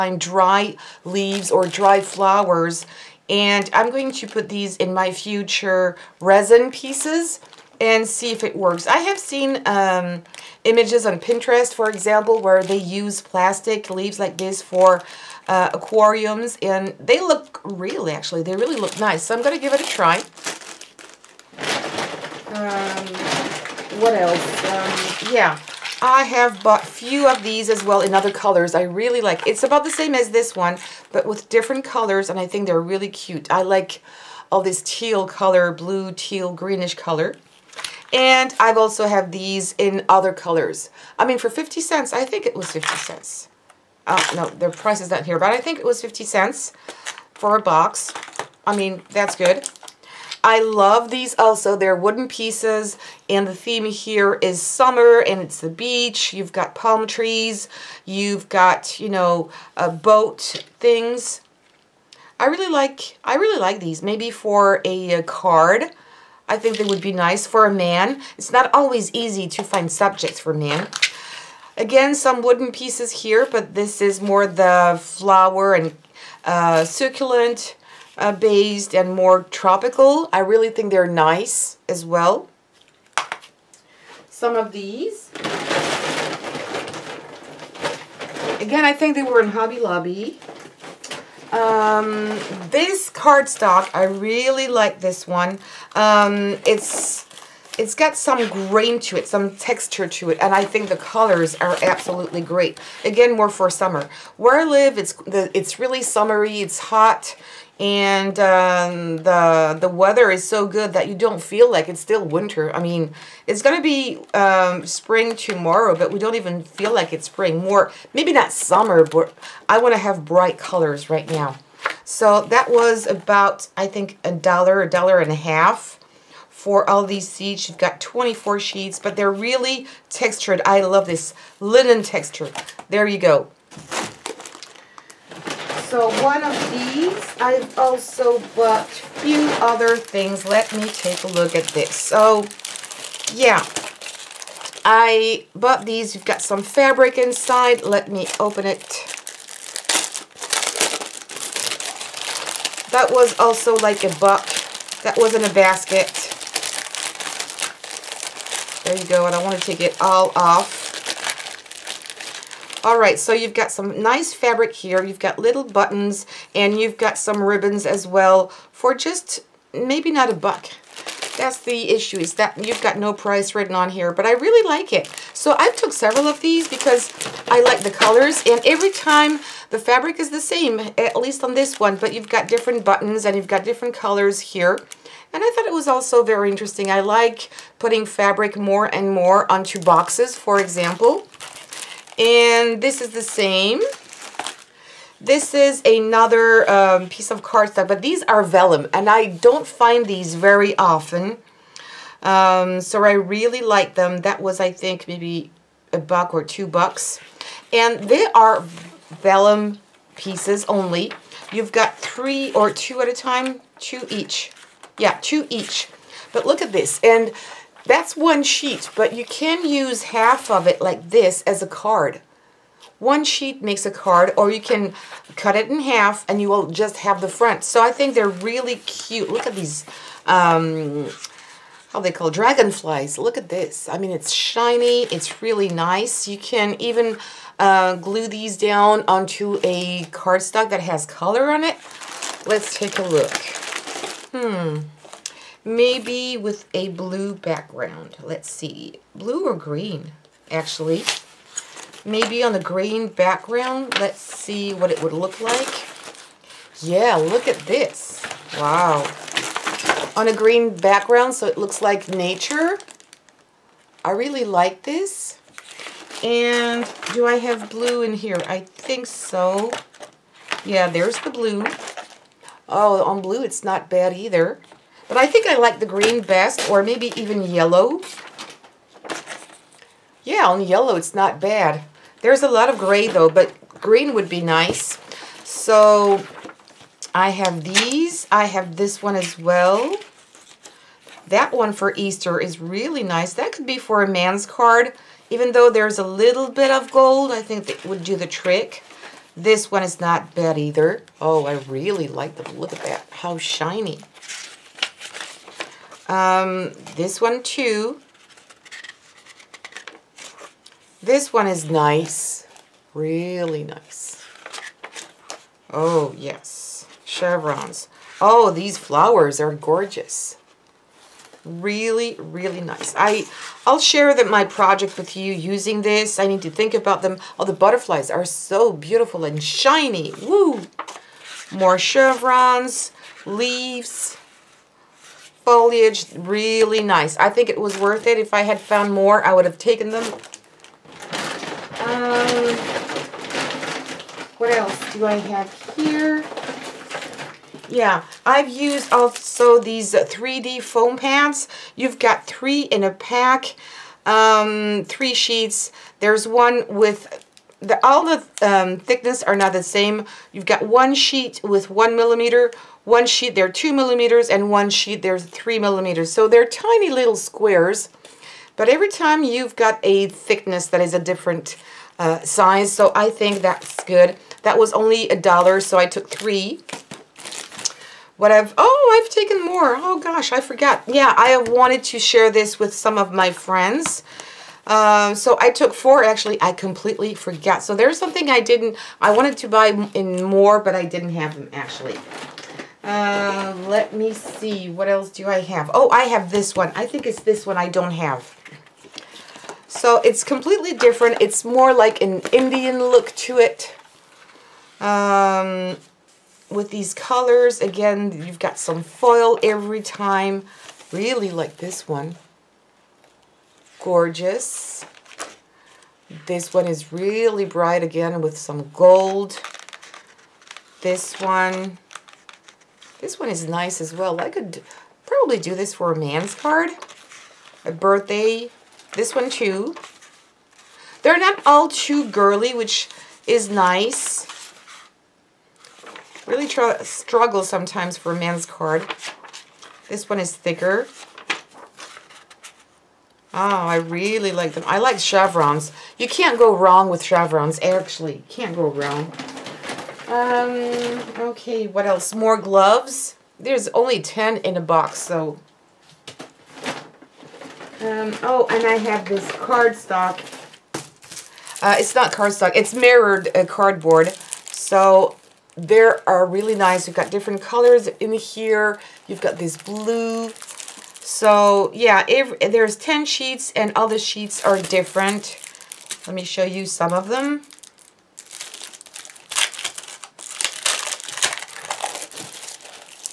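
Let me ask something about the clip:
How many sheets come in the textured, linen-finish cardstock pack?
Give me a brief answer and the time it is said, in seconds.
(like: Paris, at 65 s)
24, at 128 s.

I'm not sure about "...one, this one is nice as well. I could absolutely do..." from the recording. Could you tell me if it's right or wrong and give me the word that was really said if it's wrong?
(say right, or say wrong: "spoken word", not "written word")
wrong: "probably", not "absolutely".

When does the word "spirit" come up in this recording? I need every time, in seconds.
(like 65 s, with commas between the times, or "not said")
not said.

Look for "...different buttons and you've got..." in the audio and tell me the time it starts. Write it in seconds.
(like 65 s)
182 s.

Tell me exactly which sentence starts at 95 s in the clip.
Um, it's it's got some grain to it, some texture to it, and I think the colors are absolutely great.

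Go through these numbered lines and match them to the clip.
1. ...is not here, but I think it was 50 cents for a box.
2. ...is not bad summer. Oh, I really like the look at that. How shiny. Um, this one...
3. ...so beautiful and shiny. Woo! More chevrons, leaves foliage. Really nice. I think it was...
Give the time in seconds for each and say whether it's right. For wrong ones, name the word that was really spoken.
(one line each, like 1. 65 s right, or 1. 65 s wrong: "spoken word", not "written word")
1. 44 s right
2. 299 s wrong: "either", not "summer"
3. 328 s right.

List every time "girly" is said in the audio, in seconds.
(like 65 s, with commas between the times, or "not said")
432 s.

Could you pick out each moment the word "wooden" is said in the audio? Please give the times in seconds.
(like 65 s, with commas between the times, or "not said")
51 s, 72 s.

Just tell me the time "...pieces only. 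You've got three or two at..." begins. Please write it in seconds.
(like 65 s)
210 s.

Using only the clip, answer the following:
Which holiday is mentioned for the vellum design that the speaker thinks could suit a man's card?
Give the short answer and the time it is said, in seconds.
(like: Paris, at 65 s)
Easter, at 291 s.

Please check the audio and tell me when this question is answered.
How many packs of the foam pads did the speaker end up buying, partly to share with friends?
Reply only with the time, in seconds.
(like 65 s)
385 s.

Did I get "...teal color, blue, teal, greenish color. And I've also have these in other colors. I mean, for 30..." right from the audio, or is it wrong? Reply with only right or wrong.
wrong.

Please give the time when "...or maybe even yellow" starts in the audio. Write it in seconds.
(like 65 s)
276 s.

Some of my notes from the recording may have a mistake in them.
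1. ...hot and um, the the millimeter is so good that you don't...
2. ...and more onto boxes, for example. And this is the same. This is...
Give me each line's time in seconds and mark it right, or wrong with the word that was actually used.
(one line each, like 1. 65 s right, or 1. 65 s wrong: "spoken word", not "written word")
1. 106 s wrong: "weather", not "millimeter"
2. 188 s right.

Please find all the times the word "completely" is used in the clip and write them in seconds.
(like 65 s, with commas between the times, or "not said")
386 s, 400 s.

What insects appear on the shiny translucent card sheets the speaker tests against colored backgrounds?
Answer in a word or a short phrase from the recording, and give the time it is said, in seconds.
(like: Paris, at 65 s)
dragonflies, at 232 s.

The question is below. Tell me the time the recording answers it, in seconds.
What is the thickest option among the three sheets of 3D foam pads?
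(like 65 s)
365 s.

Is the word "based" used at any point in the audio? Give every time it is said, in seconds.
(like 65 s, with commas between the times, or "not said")
78 s.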